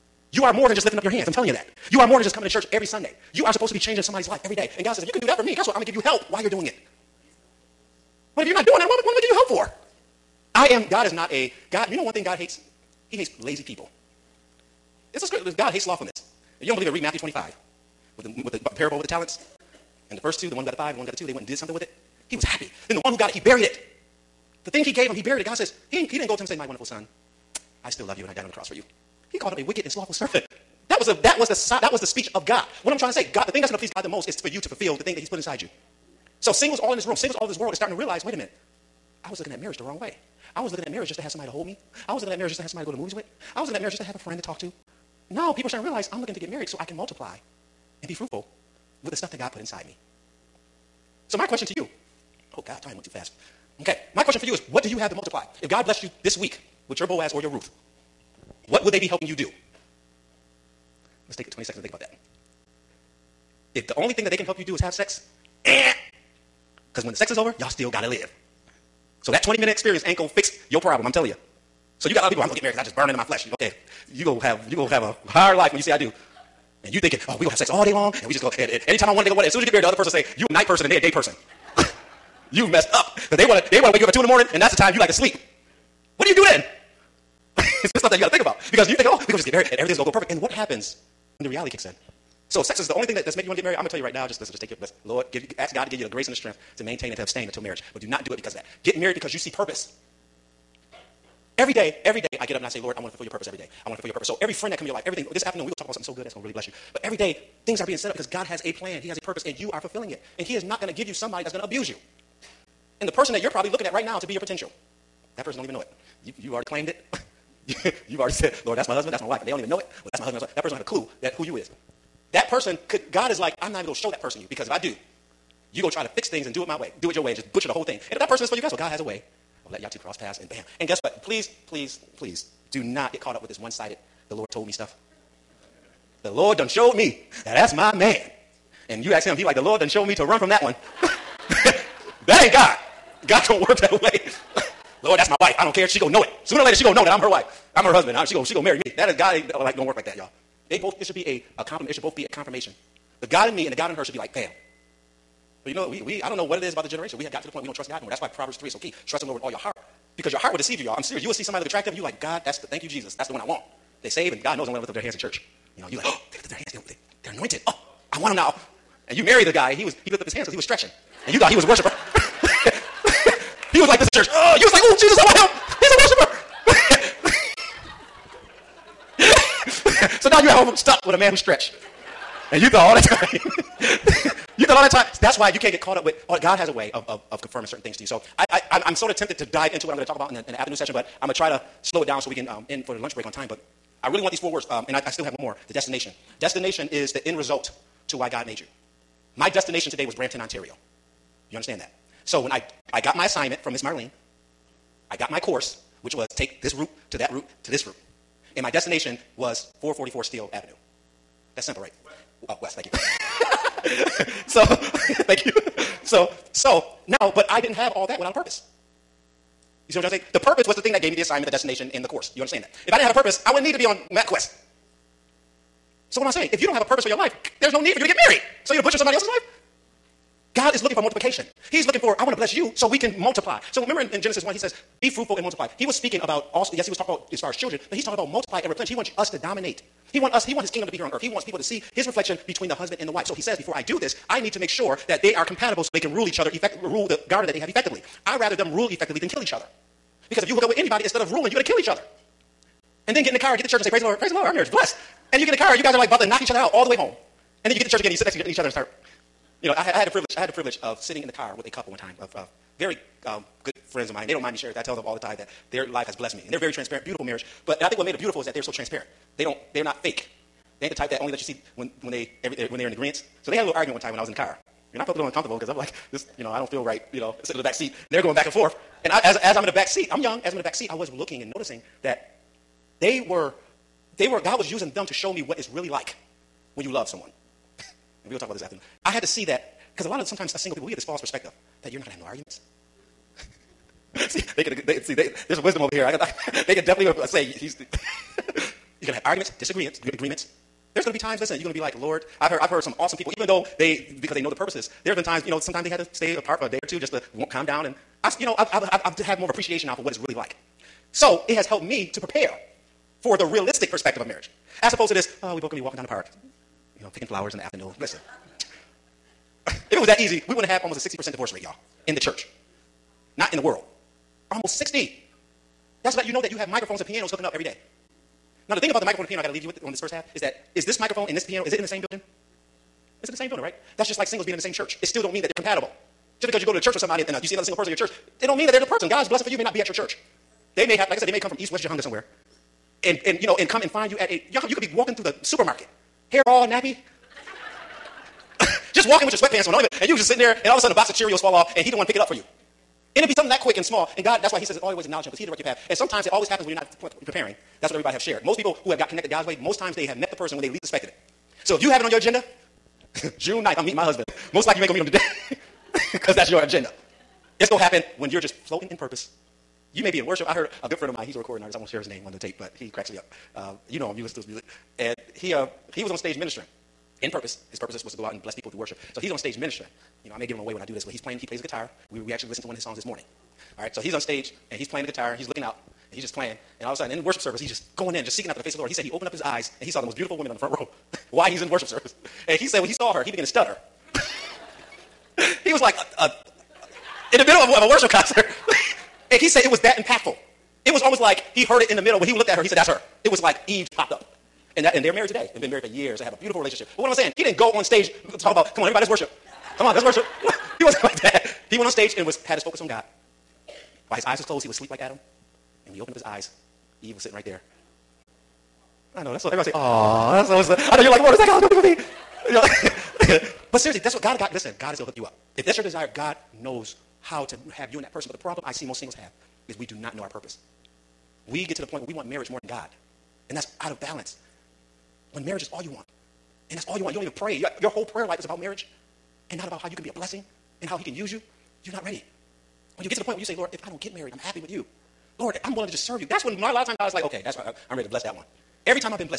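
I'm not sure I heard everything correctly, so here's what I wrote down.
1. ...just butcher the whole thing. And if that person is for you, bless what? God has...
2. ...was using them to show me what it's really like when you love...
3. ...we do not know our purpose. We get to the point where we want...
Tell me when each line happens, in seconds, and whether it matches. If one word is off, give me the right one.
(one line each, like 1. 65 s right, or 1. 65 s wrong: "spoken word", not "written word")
1. 127 s wrong: "guess", not "bless"
2. 284 s right
3. 429 s right.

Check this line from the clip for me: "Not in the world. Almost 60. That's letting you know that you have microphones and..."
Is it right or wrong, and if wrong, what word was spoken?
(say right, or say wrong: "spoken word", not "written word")
right.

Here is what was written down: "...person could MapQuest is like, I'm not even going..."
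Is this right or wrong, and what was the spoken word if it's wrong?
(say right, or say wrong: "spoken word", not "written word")
wrong: "God", not "MapQuest".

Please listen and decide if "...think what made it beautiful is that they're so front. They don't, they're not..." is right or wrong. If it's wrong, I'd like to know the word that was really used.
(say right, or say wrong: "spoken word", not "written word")
wrong: "transparent", not "front".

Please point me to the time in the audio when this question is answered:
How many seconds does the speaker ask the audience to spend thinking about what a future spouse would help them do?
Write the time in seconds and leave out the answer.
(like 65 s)
61 s.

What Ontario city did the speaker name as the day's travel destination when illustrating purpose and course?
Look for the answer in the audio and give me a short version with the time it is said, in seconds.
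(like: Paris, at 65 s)
Brampton, at 200 s.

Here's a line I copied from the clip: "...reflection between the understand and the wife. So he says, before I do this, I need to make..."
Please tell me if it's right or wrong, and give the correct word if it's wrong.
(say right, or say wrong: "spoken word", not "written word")
wrong: "husband", not "understand".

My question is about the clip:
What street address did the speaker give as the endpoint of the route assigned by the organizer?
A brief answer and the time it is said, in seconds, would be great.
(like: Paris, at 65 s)
444 Steele Avenue West, at 209 s.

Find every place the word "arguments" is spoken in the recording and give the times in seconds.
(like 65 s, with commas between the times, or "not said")
273 s, 292 s, 299 s.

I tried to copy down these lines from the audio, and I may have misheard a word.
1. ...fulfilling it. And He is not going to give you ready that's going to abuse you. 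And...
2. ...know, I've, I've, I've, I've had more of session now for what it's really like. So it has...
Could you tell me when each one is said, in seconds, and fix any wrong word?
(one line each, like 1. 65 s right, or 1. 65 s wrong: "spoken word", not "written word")
1. 109 s wrong: "somebody", not "ready"
2. 308 s wrong: "appreciation", not "session".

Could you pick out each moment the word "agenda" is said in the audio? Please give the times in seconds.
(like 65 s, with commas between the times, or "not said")
362 s, 366 s.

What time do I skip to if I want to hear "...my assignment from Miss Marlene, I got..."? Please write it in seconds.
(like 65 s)
203 s.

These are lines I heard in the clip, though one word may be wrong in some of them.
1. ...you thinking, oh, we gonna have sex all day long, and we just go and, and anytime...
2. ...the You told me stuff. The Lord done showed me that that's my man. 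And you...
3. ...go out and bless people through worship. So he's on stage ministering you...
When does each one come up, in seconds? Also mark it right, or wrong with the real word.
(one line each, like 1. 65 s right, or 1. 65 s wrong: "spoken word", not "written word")
1. 76 s right
2. 134 s wrong: "Lord", not "You"
3. 378 s right.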